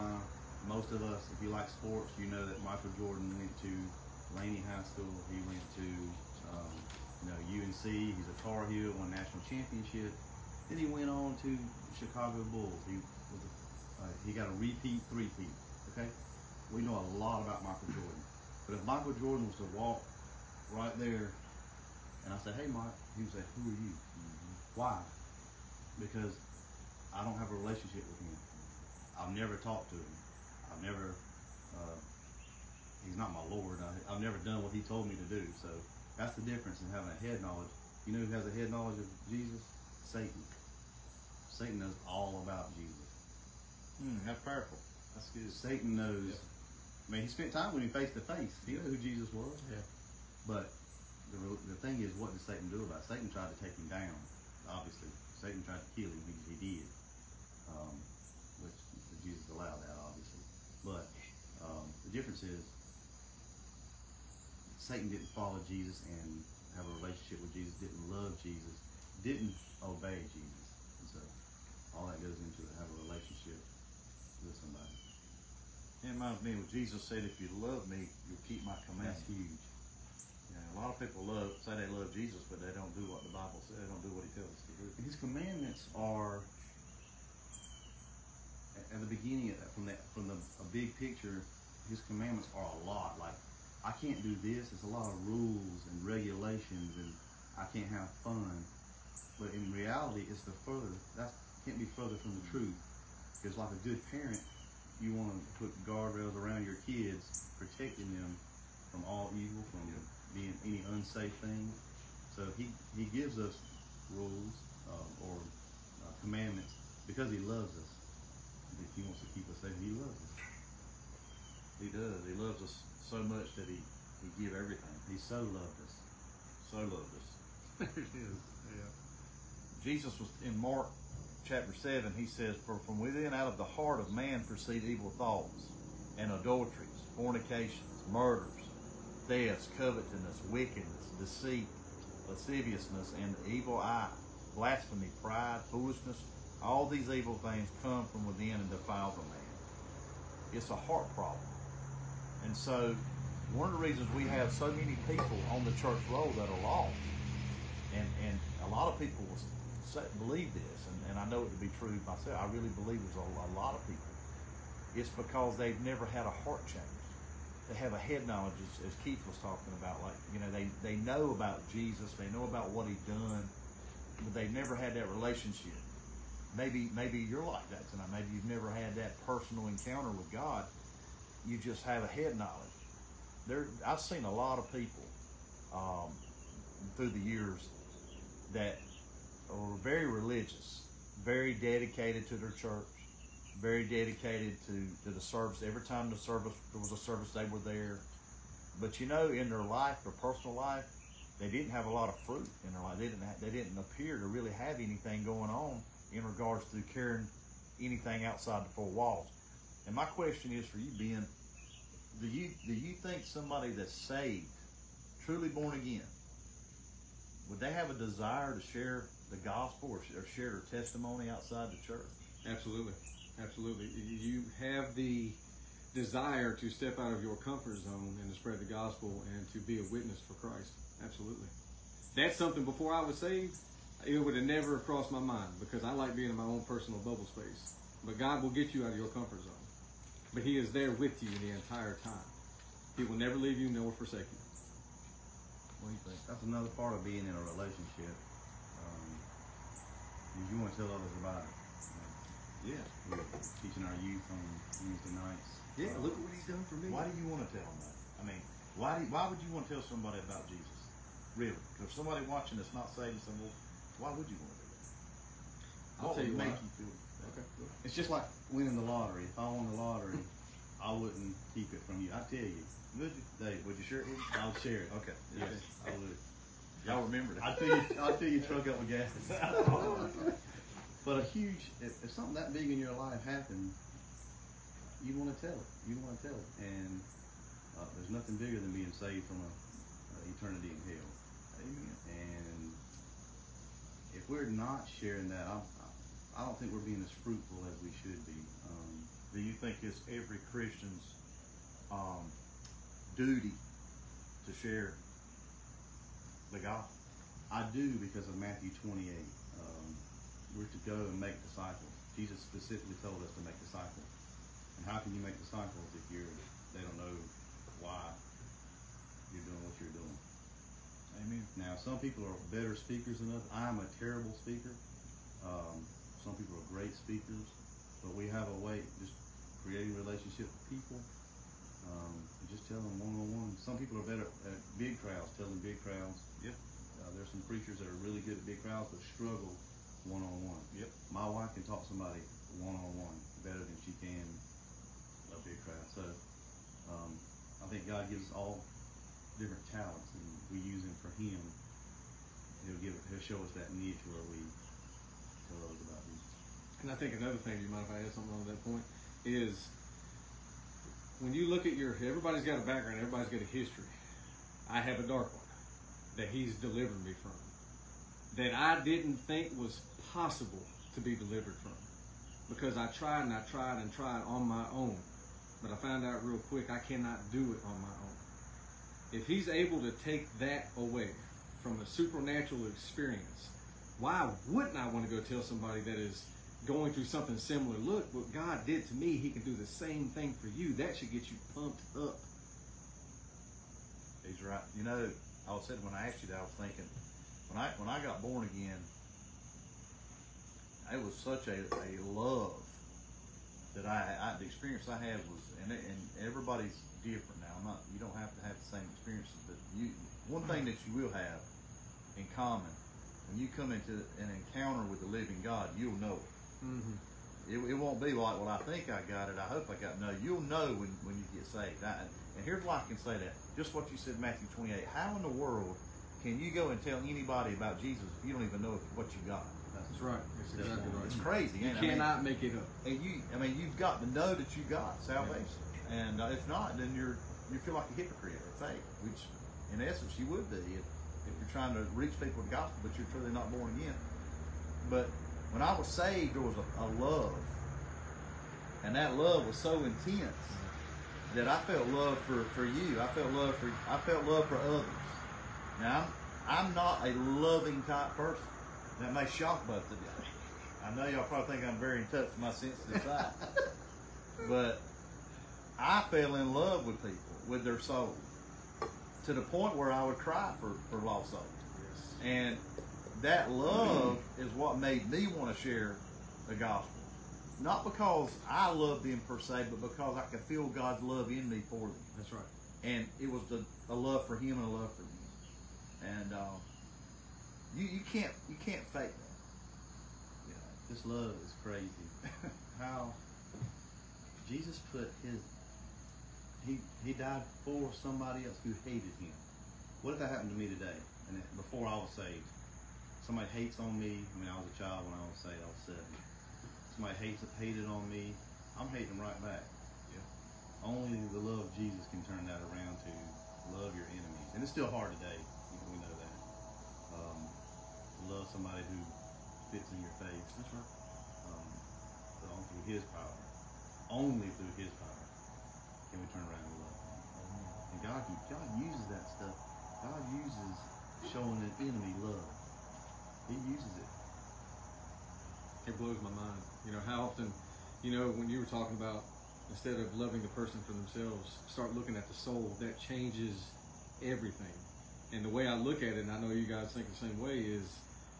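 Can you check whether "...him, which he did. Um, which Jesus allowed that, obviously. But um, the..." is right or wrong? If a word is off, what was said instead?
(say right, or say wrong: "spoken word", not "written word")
right.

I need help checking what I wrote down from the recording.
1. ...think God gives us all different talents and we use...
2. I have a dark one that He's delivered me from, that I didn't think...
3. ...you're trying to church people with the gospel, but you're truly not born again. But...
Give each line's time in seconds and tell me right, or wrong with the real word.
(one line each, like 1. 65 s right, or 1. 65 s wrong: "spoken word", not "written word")
1. 347 s right
2. 364 s right
3. 441 s wrong: "reach", not "church".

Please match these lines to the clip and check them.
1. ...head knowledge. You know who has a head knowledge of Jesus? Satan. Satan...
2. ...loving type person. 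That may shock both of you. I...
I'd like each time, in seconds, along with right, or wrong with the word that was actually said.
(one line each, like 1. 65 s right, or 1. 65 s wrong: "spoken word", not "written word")
1. 37 s right
2. 457 s right.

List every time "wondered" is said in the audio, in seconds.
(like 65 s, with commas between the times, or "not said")
not said.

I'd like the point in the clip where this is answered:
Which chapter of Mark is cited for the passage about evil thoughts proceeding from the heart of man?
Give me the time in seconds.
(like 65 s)
130 s.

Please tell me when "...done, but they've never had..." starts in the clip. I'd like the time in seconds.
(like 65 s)
173 s.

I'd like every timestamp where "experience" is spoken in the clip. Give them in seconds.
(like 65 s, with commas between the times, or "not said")
382 s, 404 s, 408 s.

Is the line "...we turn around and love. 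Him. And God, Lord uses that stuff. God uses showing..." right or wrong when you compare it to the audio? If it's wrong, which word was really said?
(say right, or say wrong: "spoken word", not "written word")
wrong: "God", not "Lord".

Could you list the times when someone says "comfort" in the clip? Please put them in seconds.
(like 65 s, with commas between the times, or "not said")
227 s, 239 s.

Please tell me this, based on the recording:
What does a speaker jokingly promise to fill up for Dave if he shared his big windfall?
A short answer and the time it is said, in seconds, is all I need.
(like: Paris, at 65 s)
your truck, at 278 s.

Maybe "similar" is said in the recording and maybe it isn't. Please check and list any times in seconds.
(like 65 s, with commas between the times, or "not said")
387 s.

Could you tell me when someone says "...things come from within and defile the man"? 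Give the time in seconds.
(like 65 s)
147 s.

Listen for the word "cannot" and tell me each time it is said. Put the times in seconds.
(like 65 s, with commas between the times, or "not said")
376 s, 431 s.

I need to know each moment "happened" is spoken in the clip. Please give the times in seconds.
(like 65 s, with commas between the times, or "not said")
283 s, 500 s.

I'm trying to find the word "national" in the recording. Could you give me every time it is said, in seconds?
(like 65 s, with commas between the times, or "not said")
9 s.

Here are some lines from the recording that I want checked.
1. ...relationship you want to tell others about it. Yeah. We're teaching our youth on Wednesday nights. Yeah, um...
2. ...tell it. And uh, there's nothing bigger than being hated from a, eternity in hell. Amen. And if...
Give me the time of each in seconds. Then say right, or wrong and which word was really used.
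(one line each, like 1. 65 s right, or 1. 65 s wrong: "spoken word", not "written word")
1. 247 s right
2. 286 s wrong: "saved", not "hated".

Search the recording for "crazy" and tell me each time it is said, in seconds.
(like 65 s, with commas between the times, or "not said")
431 s, 491 s.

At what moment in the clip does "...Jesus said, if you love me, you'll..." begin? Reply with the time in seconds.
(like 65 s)
76 s.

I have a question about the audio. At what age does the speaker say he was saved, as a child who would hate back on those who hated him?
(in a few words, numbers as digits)
7.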